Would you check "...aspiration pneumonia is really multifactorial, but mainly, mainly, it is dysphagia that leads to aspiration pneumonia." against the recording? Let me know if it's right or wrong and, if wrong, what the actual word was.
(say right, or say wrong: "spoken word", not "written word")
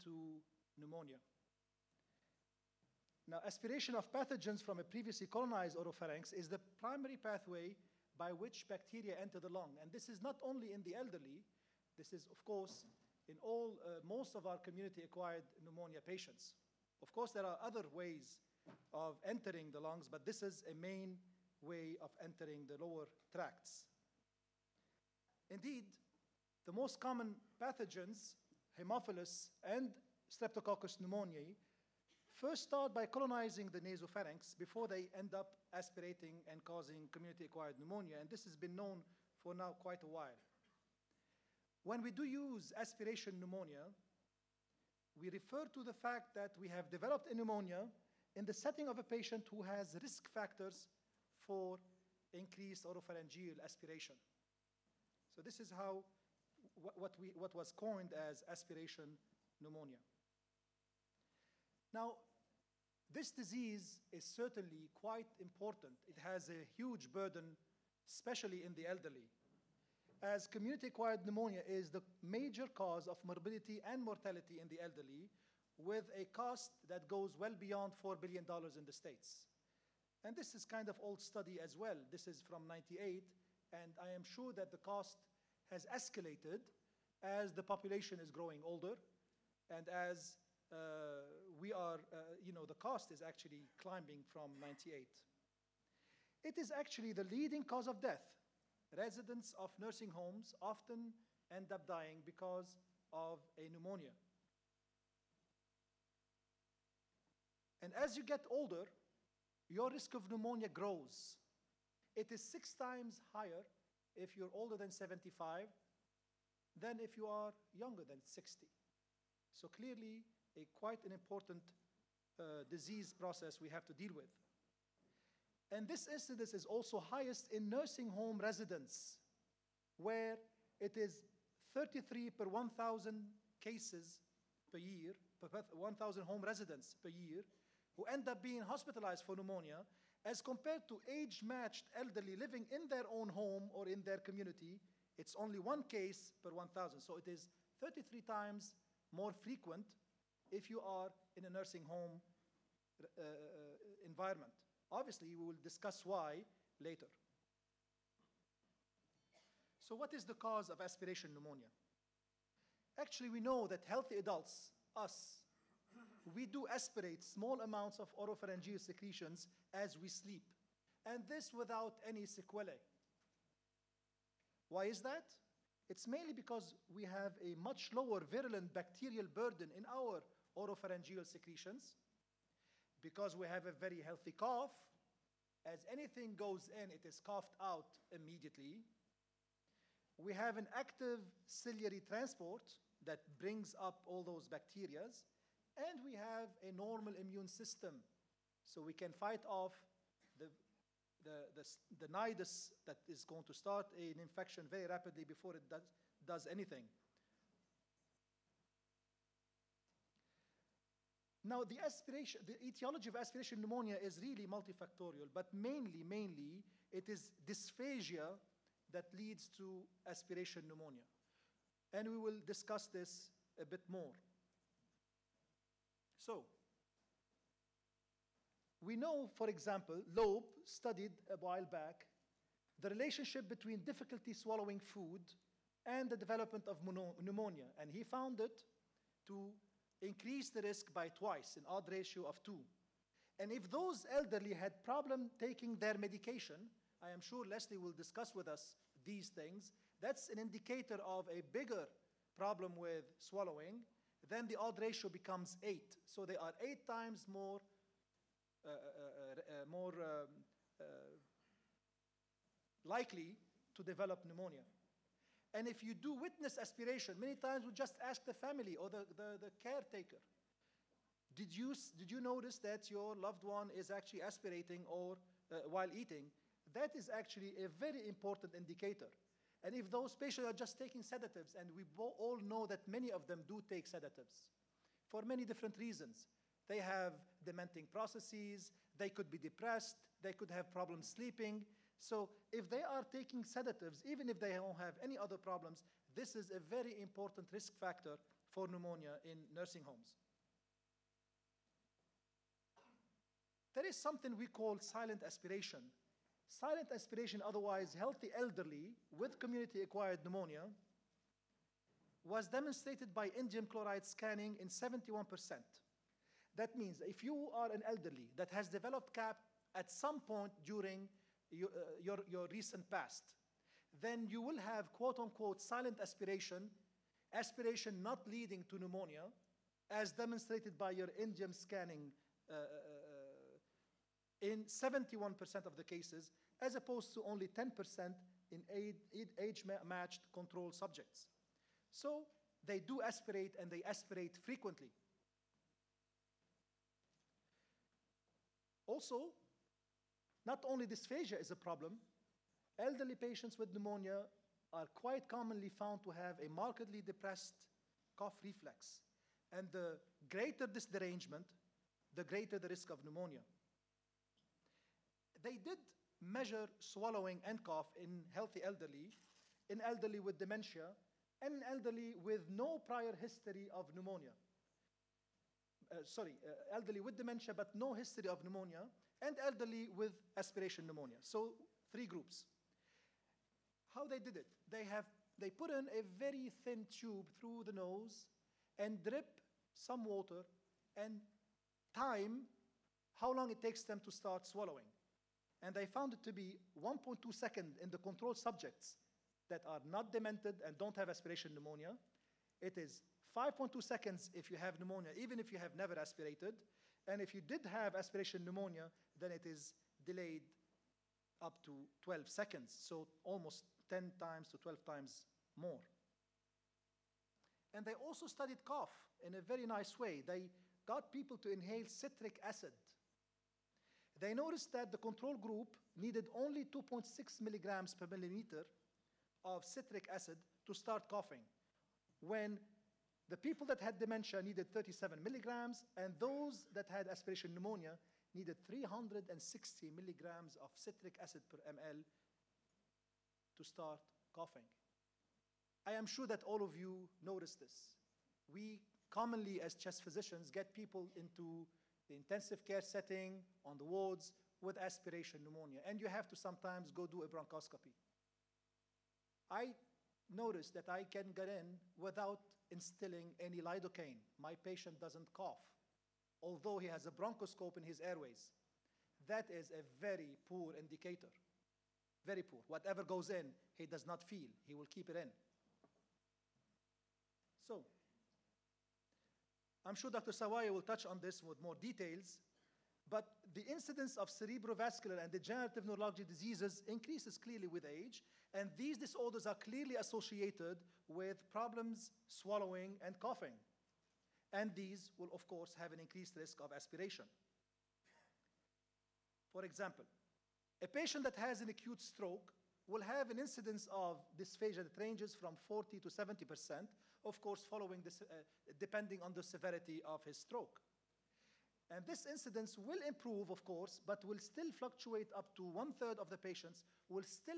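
right.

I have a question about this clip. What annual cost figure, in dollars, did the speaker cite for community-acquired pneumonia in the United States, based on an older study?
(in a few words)
$4 billion.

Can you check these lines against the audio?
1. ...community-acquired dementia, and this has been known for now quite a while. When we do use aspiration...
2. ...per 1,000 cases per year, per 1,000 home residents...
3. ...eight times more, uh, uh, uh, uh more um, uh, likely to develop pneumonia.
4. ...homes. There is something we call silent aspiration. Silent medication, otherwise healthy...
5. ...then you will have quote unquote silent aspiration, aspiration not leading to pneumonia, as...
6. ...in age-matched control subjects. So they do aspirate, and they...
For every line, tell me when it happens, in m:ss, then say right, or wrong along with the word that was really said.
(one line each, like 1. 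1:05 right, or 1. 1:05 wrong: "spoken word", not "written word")
1. 0:37 wrong: "pneumonia", not "dementia"
2. 2:12 right
3. 4:16 right
4. 4:59 wrong: "aspiration", not "medication"
5. 5:23 right
6. 5:38 right.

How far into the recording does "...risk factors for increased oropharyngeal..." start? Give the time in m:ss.
0:49.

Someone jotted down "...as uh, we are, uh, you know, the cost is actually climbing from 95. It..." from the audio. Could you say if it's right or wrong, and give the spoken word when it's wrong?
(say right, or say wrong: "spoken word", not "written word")
wrong: "98", not "95".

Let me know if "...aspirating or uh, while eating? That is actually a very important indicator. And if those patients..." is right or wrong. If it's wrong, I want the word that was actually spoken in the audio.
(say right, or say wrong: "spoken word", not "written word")
right.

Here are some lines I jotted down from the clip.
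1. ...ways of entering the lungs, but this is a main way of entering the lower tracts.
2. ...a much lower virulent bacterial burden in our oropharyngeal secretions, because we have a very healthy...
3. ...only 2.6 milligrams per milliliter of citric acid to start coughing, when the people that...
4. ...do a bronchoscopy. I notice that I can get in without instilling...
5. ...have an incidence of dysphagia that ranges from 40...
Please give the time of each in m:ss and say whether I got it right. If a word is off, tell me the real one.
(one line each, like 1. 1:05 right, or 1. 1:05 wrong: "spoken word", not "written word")
1. 0:17 right
2. 2:57 right
3. 7:06 right
4. 7:37 right
5. 8:23 right.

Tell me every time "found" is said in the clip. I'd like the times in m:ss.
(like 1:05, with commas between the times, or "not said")
3:58, 5:55, 6:35.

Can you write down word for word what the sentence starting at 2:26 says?
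So it is 33 times more frequent if you are in a nursing home uh, uh, uh, environment.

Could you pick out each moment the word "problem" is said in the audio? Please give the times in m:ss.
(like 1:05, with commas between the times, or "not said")
4:04, 4:12, 4:50, 4:55, 5:51, 8:11.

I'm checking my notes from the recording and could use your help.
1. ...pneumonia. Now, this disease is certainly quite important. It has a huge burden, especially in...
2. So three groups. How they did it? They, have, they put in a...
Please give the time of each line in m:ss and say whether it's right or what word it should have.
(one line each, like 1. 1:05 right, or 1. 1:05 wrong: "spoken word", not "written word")
1. 0:59 right
2. 6:21 right.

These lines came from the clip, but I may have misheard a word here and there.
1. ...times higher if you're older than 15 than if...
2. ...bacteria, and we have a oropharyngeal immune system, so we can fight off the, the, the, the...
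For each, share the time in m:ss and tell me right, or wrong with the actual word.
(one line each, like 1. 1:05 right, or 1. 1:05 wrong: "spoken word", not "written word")
1. 1:52 wrong: "75", not "15"
2. 3:14 wrong: "normal", not "oropharyngeal".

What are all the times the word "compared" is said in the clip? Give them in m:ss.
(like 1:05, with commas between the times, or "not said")
2:20.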